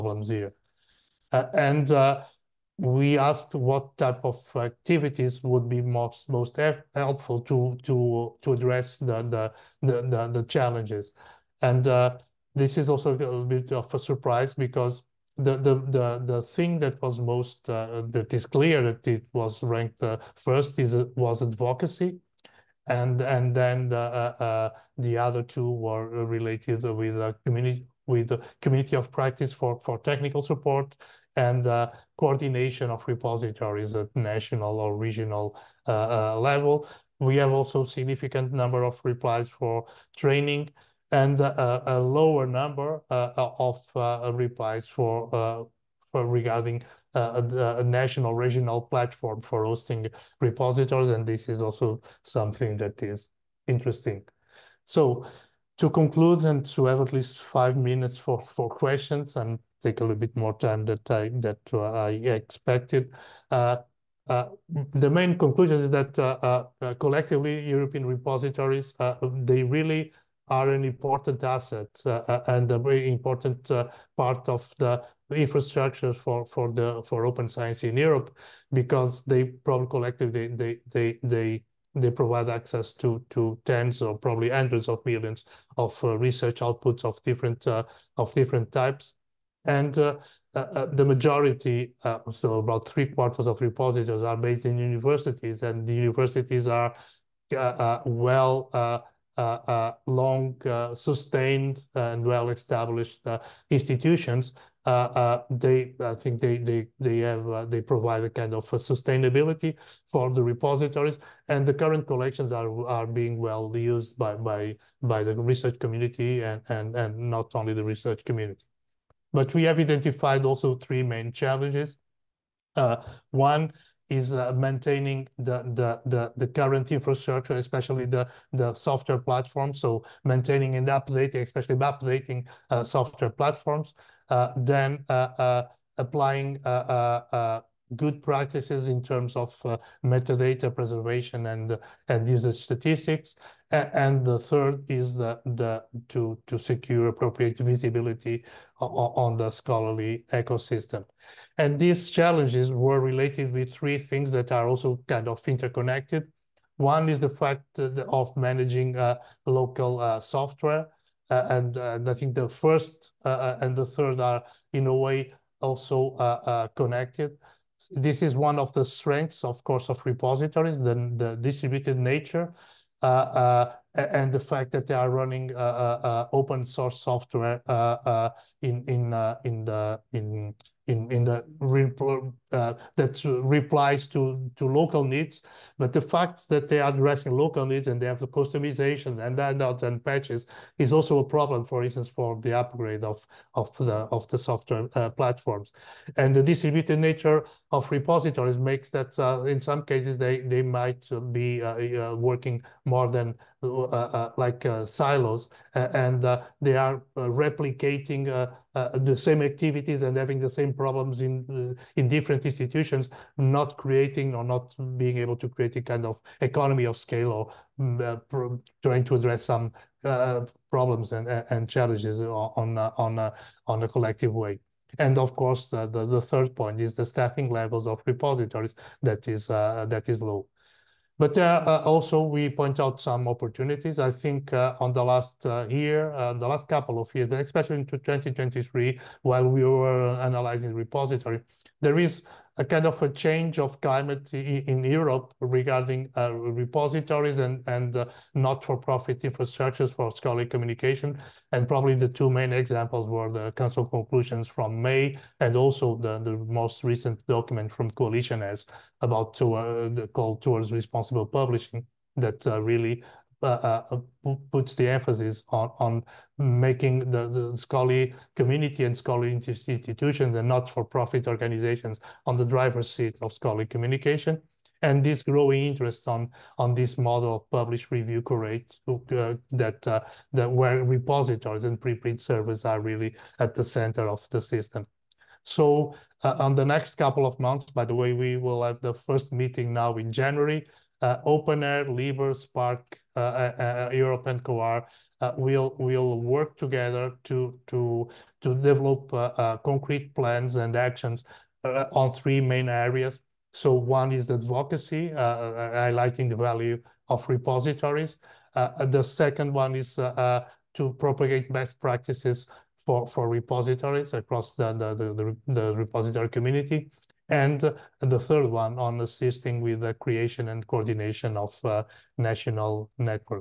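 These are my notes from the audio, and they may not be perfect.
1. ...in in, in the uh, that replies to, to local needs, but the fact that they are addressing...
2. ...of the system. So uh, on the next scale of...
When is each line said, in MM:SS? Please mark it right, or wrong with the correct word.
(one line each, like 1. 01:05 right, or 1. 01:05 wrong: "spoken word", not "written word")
1. 03:00 right
2. 04:44 wrong: "couple", not "scale".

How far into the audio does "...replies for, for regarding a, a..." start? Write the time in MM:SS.
00:44.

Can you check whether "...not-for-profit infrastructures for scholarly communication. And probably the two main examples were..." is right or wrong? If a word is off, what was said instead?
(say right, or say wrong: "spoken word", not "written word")
right.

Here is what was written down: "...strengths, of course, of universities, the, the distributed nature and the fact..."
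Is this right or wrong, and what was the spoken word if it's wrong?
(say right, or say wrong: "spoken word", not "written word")
wrong: "repositories", not "universities".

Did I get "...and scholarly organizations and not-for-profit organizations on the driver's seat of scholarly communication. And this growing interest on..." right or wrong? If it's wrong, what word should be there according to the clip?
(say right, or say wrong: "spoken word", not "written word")
wrong: "institutions", not "organizations".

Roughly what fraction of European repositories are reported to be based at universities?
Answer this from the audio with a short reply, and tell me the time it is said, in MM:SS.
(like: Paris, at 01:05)
Three quarters, at 01:32.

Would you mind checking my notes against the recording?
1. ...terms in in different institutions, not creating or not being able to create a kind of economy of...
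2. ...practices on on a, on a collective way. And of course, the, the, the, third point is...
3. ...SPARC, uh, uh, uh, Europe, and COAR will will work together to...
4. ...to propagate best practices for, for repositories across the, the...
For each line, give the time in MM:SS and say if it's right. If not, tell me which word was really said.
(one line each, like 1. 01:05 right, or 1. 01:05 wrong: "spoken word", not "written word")
1. 03:30 wrong: "problems", not "terms"
2. 03:41 wrong: "challenges", not "practices"
3. 04:52 right
4. 05:09 right.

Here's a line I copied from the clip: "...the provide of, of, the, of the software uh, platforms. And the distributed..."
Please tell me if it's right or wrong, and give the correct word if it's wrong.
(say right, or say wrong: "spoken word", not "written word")
wrong: "upgrade", not "provide".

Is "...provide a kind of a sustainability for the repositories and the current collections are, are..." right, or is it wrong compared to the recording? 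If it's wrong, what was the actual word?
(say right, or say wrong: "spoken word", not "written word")
right.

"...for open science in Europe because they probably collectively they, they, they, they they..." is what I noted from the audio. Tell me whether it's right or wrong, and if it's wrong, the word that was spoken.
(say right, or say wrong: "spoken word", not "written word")
right.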